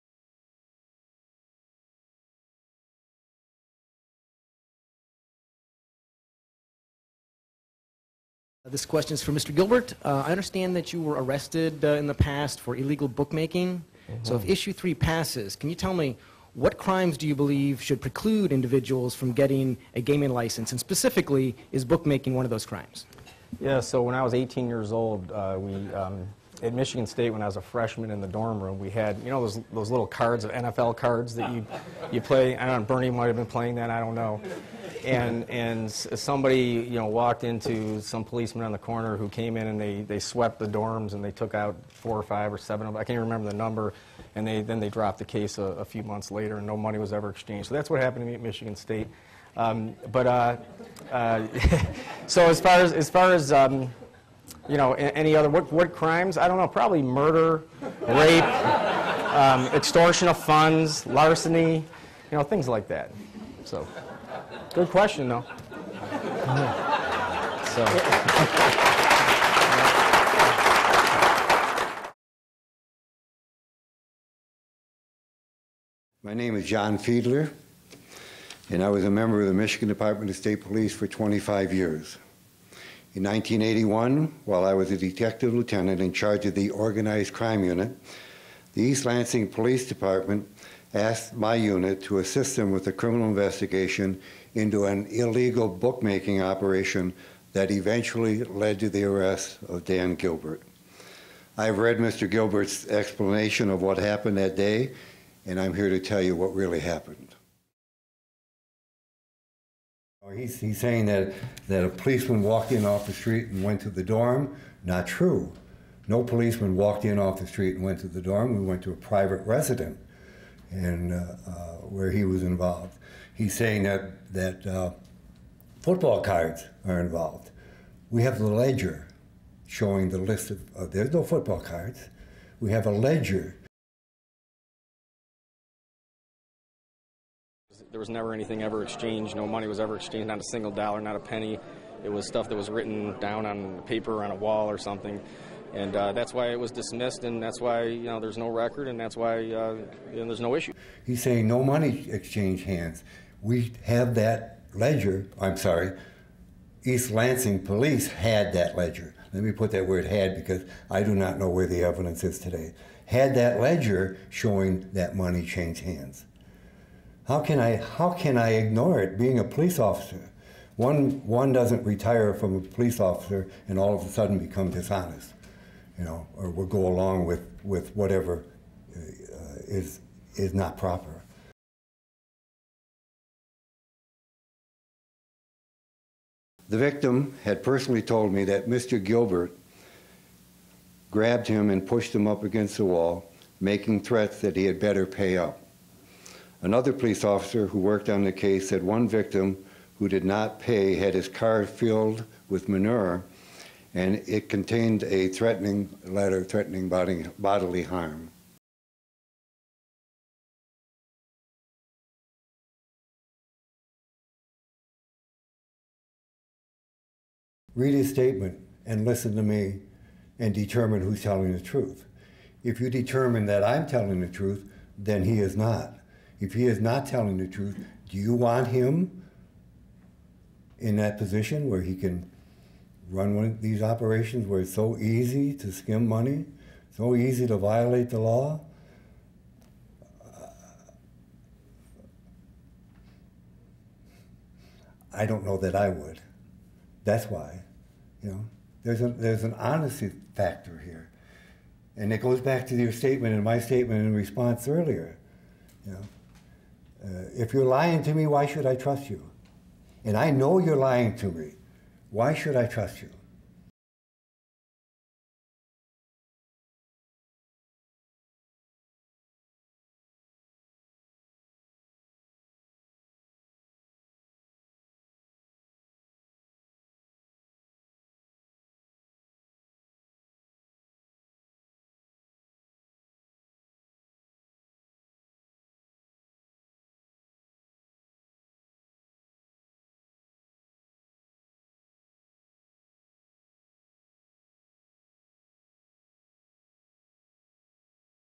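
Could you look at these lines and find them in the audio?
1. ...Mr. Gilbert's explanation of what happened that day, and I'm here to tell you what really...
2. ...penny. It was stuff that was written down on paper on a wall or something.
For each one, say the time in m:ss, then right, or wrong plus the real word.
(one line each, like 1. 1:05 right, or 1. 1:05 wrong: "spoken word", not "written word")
1. 1:41 right
2. 2:21 right.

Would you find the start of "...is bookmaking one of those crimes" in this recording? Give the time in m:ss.
0:21.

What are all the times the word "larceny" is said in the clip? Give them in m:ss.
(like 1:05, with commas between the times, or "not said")
1:01.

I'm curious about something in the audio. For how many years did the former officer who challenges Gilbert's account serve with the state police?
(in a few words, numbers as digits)
25.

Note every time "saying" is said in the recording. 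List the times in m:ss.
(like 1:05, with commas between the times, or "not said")
1:50, 2:03, 2:31.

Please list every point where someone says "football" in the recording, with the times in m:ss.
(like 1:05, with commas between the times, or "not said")
2:05, 2:11.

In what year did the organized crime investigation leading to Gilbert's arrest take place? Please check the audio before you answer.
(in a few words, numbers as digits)
1981.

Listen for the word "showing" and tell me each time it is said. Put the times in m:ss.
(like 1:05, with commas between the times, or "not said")
2:09, 2:44.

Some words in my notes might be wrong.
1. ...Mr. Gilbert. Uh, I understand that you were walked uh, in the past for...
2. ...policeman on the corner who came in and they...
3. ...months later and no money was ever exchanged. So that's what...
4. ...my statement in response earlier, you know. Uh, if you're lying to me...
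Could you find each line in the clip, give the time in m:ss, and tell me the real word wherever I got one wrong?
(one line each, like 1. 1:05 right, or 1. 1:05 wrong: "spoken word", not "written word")
1. 0:09 wrong: "arrested", not "walked"
2. 0:38 right
3. 0:46 right
4. 4:13 right.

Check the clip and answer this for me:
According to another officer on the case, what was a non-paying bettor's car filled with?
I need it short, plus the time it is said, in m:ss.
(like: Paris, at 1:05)
Manure, at 3:22.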